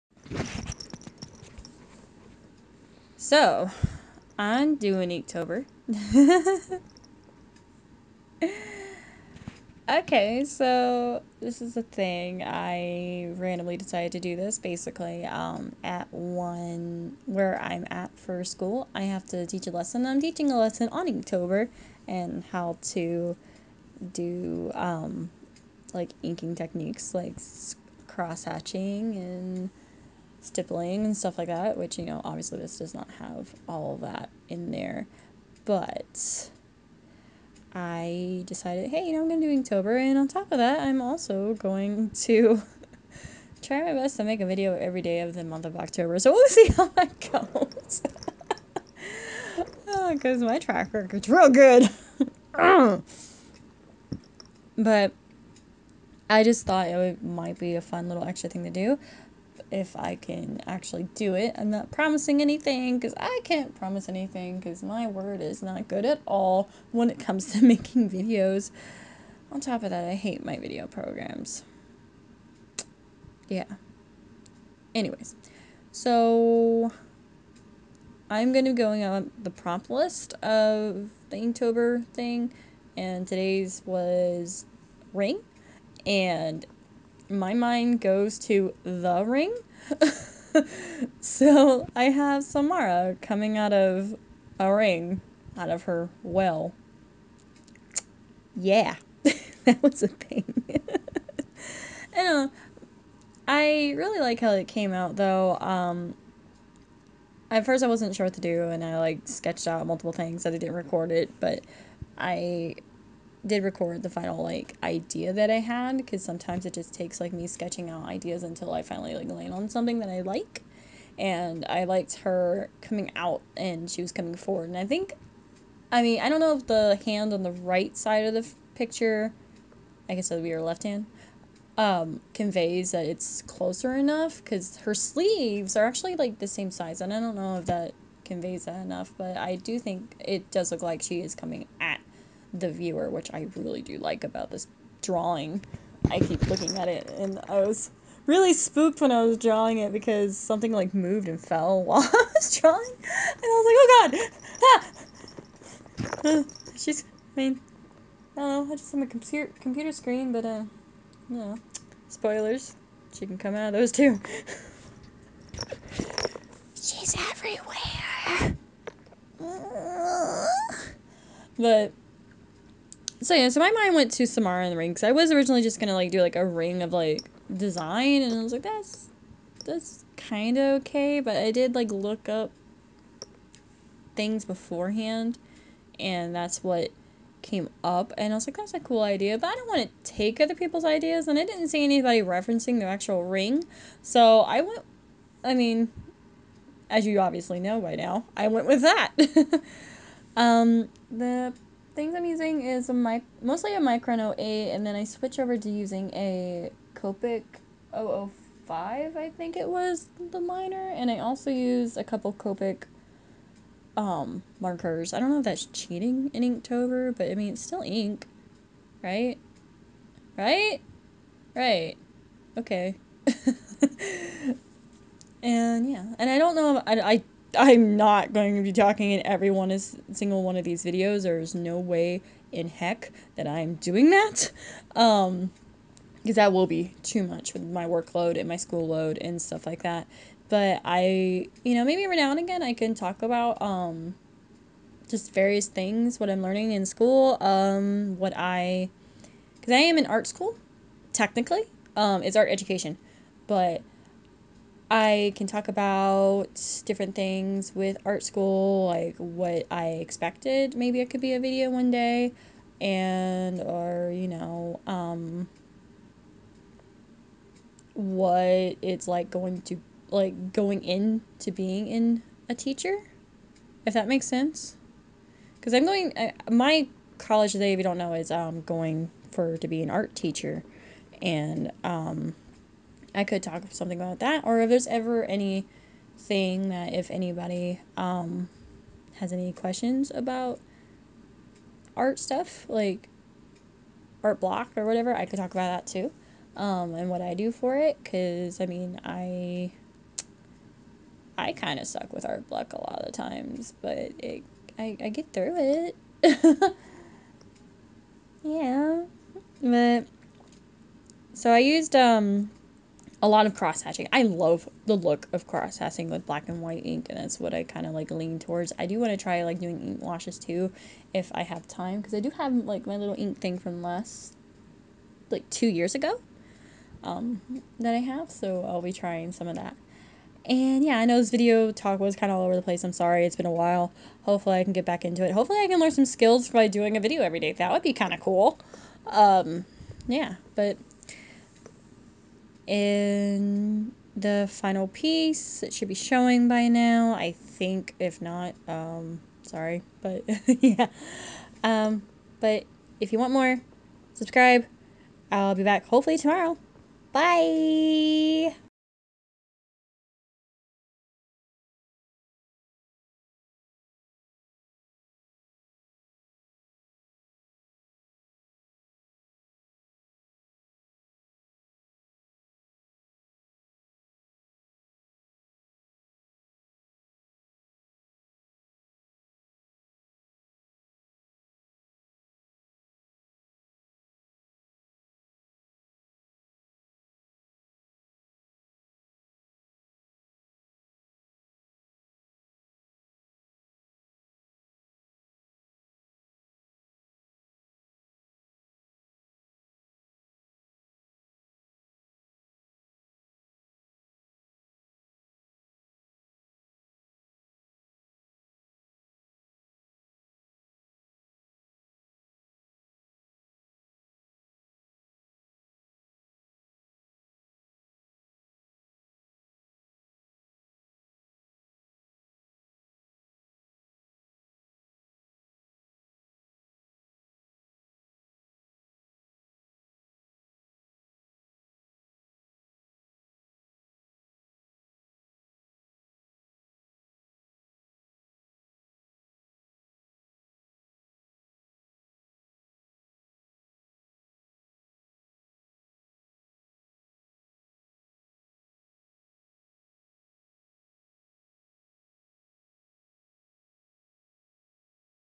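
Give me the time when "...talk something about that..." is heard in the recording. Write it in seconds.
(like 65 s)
283 s.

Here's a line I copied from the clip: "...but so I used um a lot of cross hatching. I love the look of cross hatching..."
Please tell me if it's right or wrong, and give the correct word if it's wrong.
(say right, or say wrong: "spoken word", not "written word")
right.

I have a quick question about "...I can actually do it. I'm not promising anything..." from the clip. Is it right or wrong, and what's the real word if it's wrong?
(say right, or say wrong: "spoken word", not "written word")
right.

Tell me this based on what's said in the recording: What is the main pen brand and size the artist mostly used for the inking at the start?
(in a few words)
Micron 08.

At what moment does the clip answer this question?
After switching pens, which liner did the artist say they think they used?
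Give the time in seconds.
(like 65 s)
206 s.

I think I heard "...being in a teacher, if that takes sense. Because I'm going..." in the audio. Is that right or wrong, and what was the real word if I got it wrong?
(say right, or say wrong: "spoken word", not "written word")
wrong: "makes", not "takes".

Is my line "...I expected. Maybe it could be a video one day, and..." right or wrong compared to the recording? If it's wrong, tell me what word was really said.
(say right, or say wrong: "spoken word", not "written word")
right.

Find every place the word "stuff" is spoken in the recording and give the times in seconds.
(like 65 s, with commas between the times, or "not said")
31 s, 239 s, 292 s.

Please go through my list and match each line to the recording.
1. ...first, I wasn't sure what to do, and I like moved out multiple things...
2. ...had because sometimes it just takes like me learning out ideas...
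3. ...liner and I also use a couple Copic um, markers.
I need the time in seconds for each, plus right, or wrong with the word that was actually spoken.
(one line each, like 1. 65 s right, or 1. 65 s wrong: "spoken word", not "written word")
1. 107 s wrong: "sketched", not "moved"
2. 115 s wrong: "sketching", not "learning"
3. 210 s right.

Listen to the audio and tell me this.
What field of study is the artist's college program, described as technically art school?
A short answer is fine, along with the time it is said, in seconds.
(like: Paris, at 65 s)
Art education, at 252 s.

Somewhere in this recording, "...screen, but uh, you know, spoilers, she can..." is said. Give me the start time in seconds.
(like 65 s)
159 s.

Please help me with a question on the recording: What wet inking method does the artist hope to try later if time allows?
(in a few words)
Ink washes.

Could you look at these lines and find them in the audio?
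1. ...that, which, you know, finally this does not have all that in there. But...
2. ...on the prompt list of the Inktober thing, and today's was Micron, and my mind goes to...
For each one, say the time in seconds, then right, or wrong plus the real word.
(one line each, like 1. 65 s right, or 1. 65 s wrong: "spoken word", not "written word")
1. 31 s wrong: "obviously", not "finally"
2. 79 s wrong: "Ring", not "Micron".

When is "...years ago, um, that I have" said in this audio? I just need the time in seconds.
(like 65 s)
325 s.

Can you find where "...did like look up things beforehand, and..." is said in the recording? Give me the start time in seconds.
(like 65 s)
181 s.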